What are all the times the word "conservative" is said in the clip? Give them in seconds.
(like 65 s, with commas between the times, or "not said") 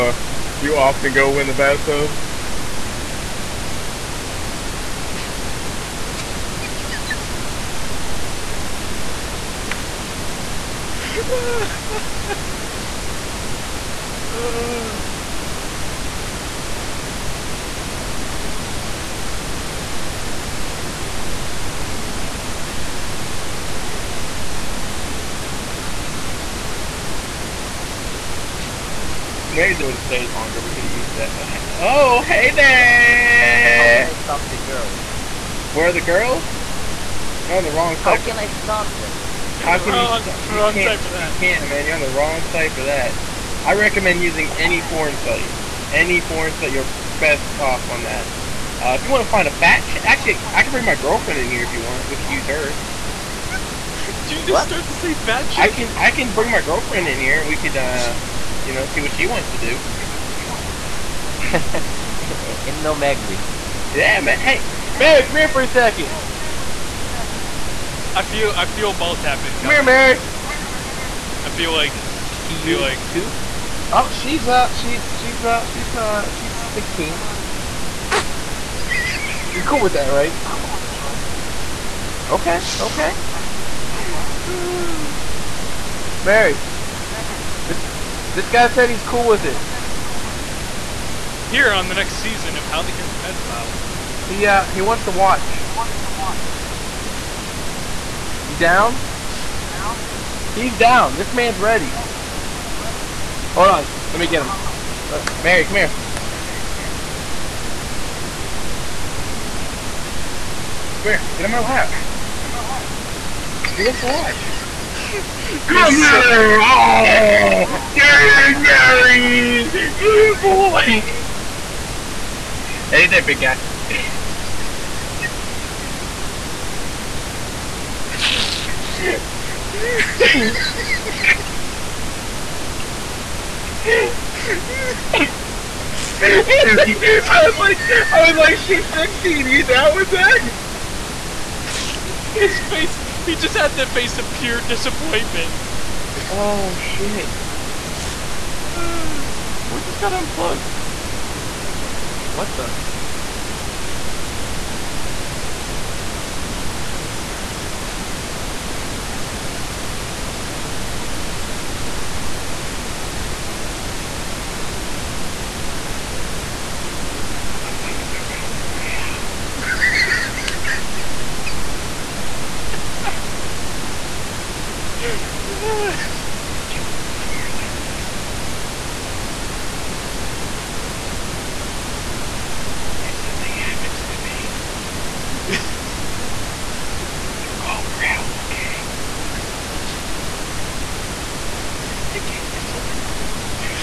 not said.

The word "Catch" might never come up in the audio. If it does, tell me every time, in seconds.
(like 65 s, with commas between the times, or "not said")
92 s.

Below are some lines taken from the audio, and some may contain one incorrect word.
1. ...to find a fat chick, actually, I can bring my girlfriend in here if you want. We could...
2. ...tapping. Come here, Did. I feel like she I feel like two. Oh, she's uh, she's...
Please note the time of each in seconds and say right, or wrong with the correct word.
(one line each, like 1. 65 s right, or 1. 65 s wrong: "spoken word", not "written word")
1. 49 s right
2. 69 s wrong: "Mary", not "Did".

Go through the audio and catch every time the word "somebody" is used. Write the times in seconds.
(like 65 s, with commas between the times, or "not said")
168 s.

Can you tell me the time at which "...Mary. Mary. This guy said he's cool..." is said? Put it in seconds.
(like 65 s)
86 s.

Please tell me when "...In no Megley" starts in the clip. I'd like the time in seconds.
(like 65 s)
62 s.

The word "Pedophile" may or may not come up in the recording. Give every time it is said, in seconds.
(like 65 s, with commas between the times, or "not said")
93 s.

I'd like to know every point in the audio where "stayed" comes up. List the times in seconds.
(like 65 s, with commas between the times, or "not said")
30 s.